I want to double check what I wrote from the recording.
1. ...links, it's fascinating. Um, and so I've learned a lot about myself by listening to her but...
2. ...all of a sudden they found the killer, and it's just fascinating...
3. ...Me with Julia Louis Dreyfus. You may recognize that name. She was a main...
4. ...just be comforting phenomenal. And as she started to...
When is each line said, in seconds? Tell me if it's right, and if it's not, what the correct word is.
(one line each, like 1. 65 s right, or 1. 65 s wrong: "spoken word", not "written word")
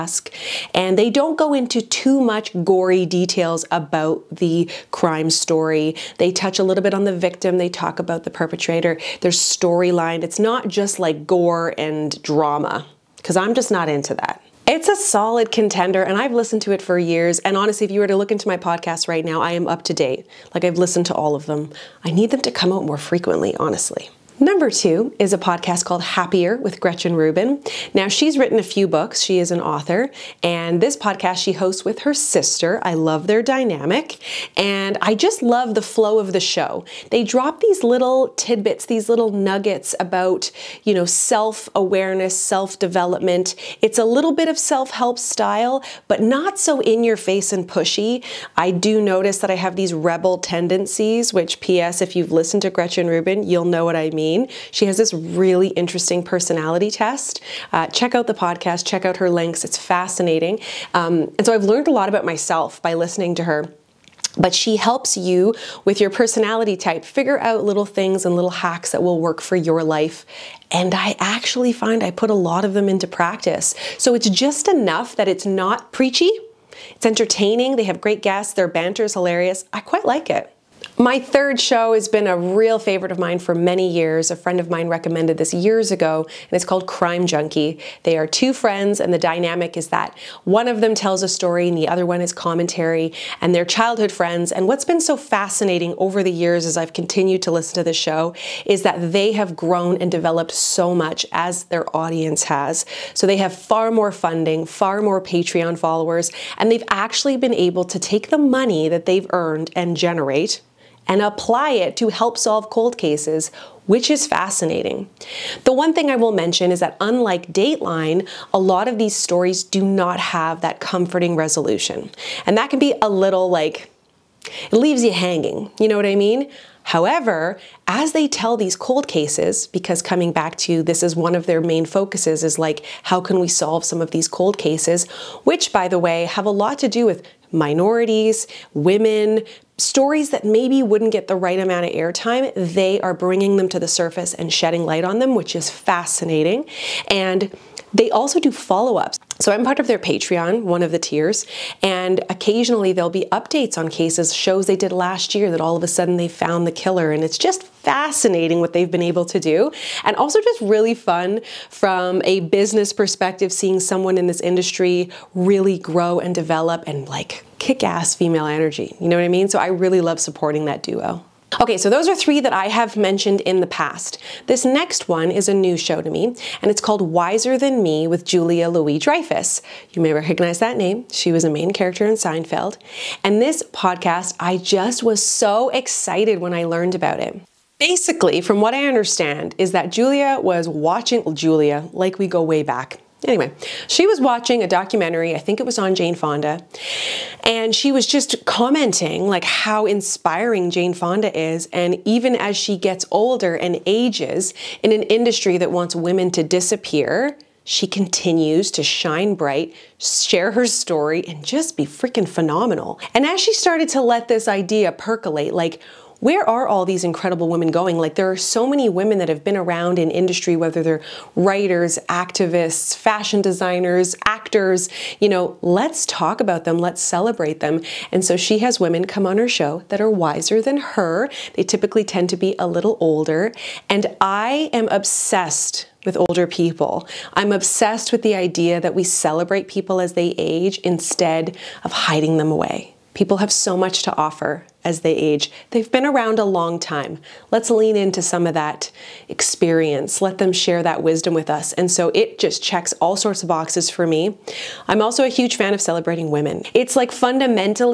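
1. 59 s right
2. 155 s right
3. 177 s right
4. 211 s wrong: "freaking", not "comforting".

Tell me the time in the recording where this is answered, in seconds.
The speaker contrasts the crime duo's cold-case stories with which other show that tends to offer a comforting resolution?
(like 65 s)
117 s.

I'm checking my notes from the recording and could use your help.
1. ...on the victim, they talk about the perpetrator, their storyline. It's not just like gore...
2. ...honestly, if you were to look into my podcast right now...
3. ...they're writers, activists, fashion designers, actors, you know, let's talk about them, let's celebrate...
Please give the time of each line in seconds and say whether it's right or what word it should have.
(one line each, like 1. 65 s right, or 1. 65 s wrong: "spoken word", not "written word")
1. 6 s right
2. 17 s right
3. 220 s right.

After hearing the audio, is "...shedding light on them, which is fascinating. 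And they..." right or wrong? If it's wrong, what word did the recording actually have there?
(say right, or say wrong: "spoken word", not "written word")
right.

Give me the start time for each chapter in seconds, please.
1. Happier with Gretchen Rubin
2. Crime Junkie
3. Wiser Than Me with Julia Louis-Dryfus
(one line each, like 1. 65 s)
1. 24 s
2. 80 s
3. 171 s.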